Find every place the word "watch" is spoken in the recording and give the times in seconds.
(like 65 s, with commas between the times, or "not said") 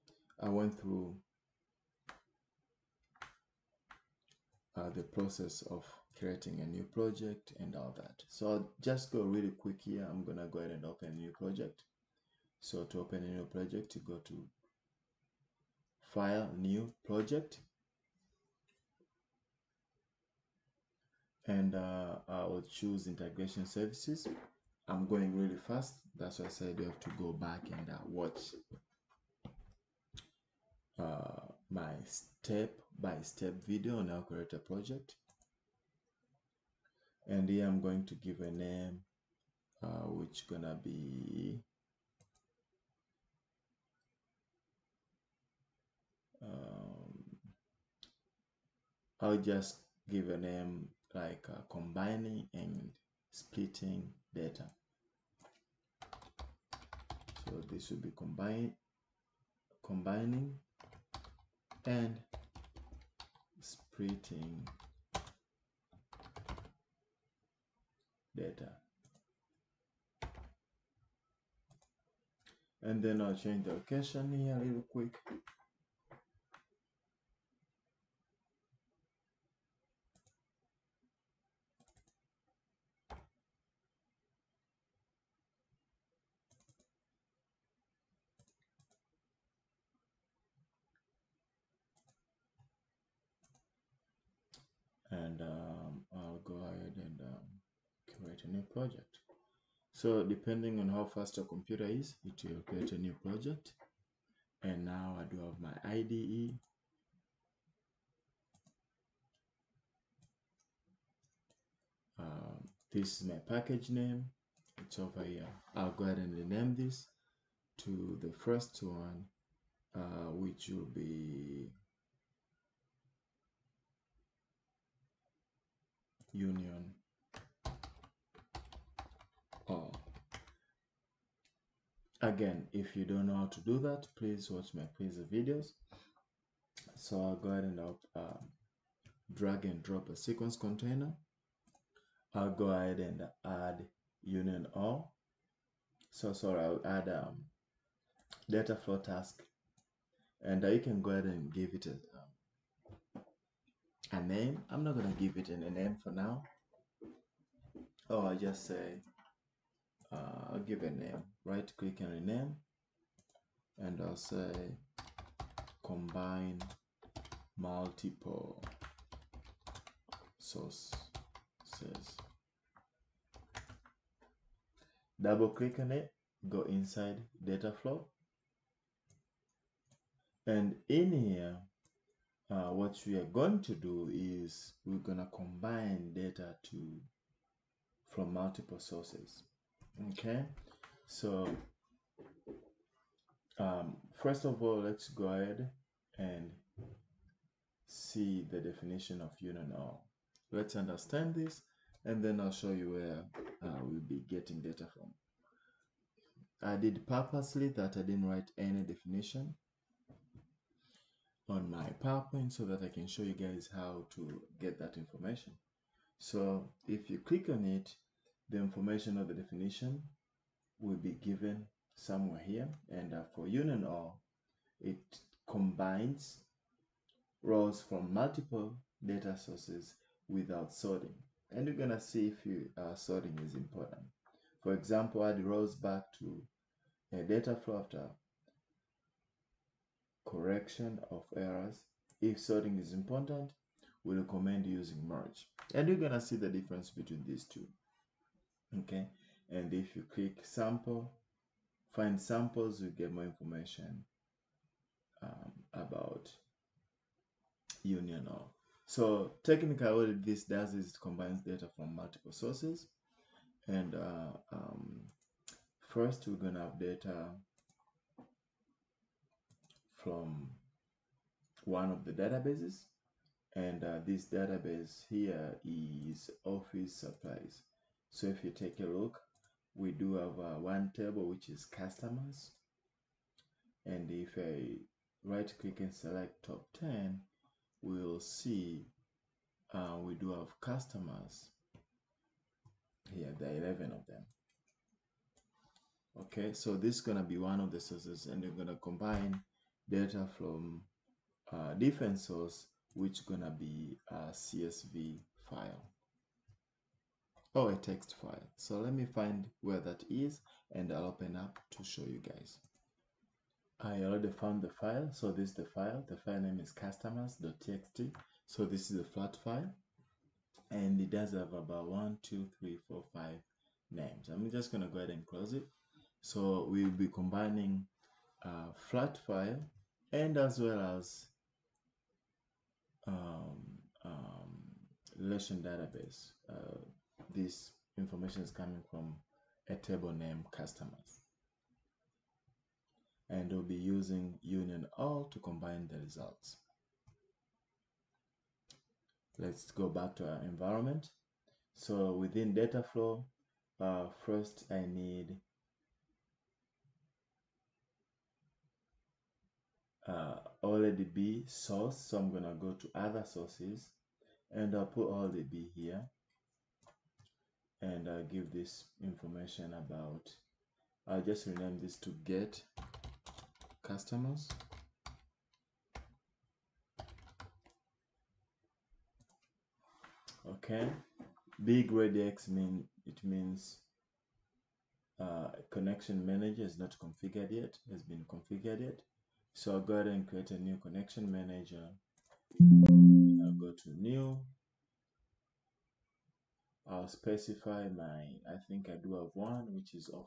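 28 s, 134 s.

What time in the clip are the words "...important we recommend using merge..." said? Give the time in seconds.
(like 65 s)
242 s.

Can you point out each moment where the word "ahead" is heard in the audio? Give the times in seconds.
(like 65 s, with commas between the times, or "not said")
10 s, 116 s, 137 s, 142 s, 151 s, 195 s, 324 s, 389 s.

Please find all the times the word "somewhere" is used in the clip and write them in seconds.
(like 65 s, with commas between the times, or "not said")
221 s.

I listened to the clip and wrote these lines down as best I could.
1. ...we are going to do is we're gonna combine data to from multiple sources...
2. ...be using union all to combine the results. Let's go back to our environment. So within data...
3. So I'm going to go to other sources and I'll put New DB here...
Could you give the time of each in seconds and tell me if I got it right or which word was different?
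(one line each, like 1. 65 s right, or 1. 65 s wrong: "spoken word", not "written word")
1. 183 s right
2. 343 s right
3. 361 s wrong: "OLE", not "New".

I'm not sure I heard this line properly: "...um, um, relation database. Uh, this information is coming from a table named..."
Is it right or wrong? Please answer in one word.
right.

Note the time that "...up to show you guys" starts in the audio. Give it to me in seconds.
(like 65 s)
311 s.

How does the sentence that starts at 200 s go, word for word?
Let's understand this and then I'll show you where uh, we'll be getting data from.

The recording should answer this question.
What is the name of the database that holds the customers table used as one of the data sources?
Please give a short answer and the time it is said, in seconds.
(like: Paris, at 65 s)
office supplies, at 276 s.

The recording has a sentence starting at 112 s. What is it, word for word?
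Um, this is my package name.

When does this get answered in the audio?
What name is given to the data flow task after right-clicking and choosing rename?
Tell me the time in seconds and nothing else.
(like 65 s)
165 s.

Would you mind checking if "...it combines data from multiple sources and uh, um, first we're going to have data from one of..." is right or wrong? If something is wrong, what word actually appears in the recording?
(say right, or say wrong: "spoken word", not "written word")
right.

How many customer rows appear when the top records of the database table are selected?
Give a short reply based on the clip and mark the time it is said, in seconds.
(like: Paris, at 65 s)
11, at 293 s.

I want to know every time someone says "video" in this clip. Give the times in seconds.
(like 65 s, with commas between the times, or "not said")
33 s, 135 s.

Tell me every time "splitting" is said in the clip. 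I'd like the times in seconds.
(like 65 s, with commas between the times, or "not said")
53 s, 63 s.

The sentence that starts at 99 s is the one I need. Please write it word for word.
So depending on how fast your computer is, it will create a new project.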